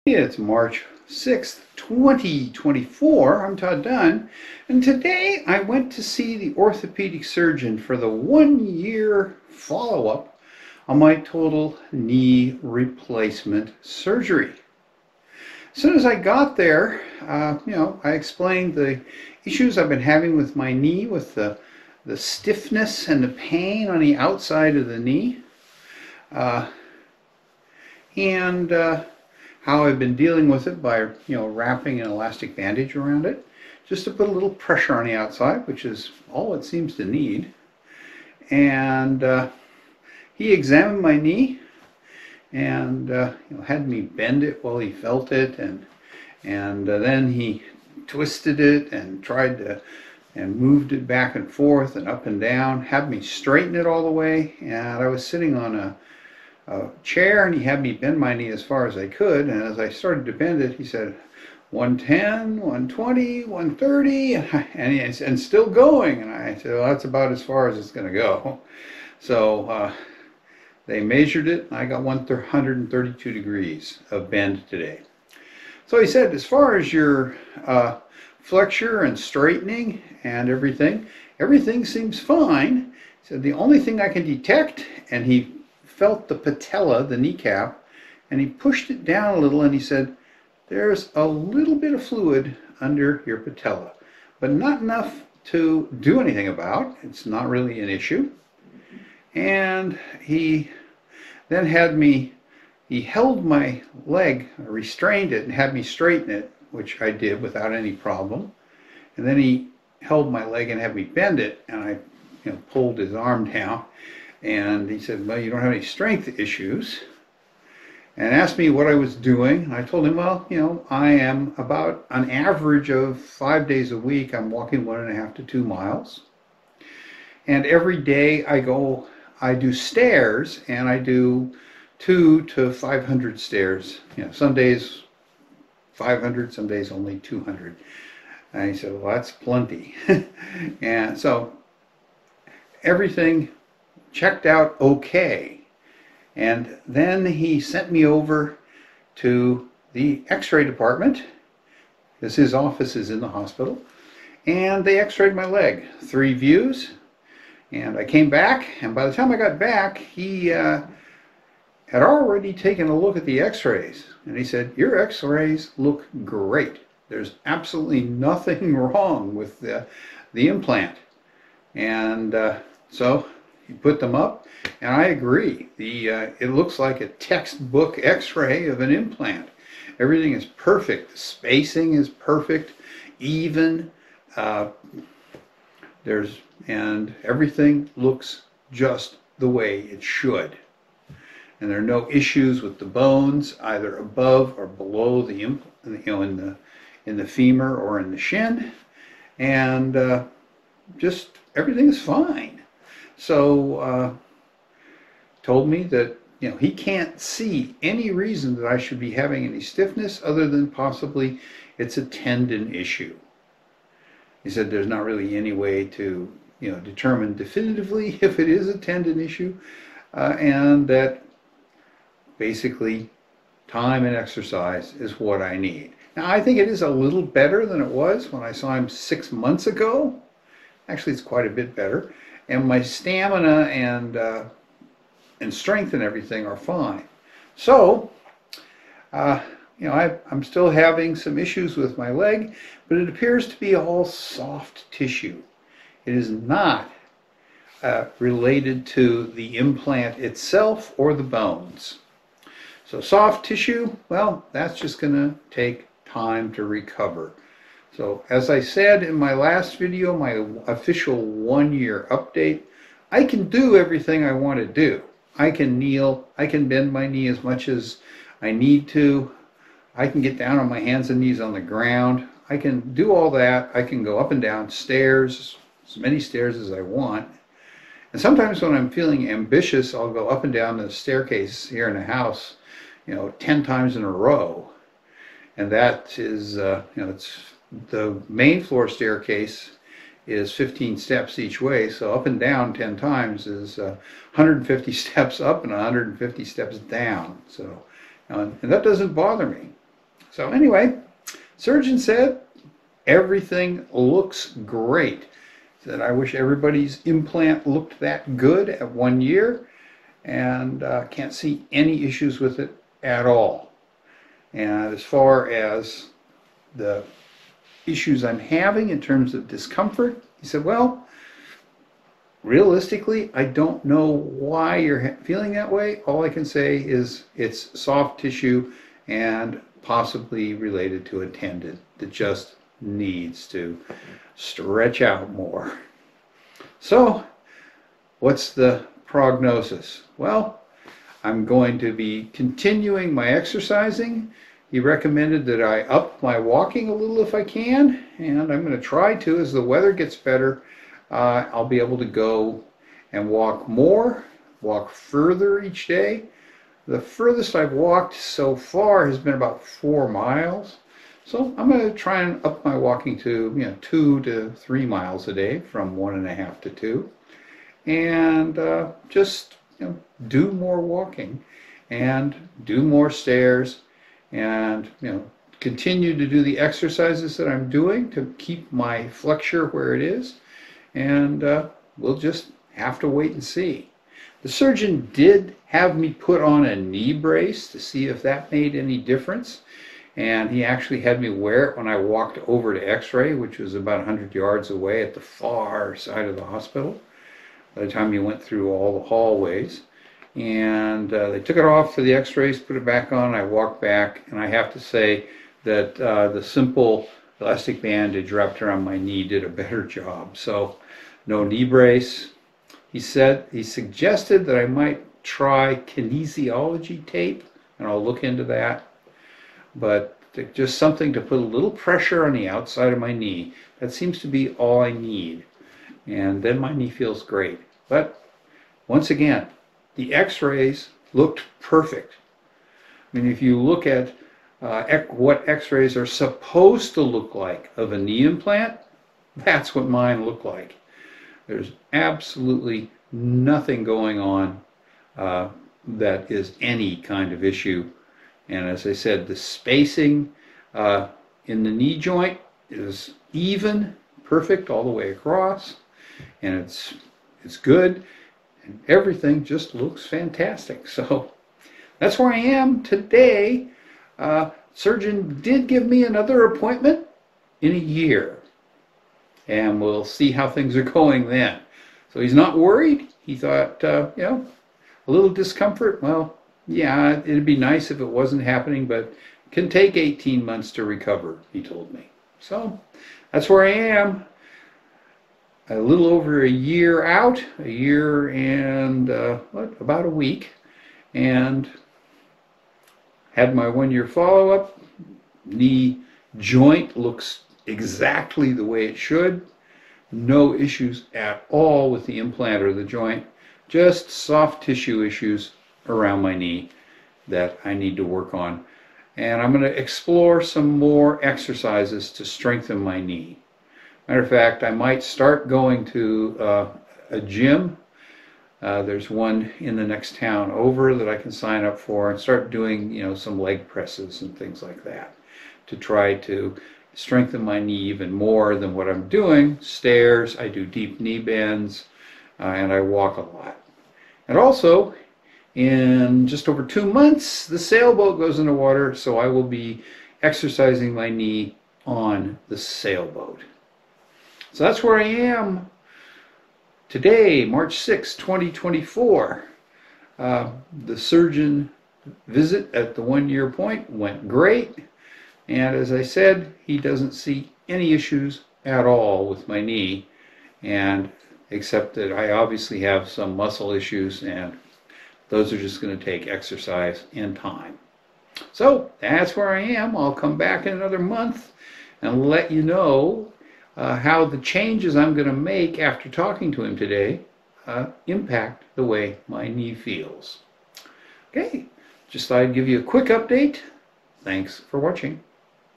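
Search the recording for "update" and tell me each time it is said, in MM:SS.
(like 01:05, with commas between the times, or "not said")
04:22, 09:43.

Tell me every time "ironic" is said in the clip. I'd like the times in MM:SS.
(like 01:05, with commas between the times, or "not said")
not said.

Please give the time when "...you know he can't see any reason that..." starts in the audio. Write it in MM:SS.
03:26.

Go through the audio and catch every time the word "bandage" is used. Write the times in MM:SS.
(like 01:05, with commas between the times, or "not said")
00:32, 06:47.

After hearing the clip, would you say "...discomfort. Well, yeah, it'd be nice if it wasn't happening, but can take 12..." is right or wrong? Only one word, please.
wrong.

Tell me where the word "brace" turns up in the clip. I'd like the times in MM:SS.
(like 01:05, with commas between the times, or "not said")
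06:27, 06:51.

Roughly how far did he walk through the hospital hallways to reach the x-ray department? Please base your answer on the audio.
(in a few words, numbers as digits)
About 100 yards.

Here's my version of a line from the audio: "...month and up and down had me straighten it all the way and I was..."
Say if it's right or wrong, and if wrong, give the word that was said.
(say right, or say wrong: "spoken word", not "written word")
wrong: "forth", not "month".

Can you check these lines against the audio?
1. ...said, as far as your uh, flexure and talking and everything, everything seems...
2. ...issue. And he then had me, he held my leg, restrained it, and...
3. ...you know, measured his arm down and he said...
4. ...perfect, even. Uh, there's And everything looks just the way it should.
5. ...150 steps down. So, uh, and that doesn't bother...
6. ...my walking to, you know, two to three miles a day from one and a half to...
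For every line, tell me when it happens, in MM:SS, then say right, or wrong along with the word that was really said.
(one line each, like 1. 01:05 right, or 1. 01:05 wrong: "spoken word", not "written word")
1. 01:16 wrong: "straightening", not "talking"
2. 01:37 right
3. 01:52 wrong: "pulled", not "measured"
4. 03:02 right
5. 04:55 right
6. 06:02 right.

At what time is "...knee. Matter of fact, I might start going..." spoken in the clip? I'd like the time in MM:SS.
08:32.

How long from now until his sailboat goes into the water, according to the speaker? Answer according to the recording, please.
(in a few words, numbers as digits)
Just over 2 months.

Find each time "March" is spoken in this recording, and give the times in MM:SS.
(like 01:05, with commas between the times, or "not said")
00:00, 09:07.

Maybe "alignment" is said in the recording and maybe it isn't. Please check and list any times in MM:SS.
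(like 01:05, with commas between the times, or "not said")
not said.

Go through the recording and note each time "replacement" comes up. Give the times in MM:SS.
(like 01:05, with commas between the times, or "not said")
00:12.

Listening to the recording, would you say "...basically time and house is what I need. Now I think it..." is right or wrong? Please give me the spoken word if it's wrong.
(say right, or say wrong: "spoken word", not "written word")
wrong: "exercise", not "house".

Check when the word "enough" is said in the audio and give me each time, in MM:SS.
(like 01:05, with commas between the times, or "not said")
01:34.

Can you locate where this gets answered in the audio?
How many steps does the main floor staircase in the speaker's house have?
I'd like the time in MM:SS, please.
04:50.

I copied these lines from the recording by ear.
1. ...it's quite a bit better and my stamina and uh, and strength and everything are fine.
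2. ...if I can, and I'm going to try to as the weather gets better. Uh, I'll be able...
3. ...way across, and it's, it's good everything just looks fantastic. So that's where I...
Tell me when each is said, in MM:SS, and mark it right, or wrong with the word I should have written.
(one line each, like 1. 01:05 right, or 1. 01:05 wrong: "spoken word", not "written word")
1. 03:51 right
2. 05:47 right
3. 07:34 right.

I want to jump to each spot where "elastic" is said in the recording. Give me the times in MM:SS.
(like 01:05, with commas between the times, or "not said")
00:32, 06:47.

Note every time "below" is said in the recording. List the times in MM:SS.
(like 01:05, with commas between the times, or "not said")
03:14.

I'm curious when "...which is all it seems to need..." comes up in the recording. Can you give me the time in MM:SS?
00:35.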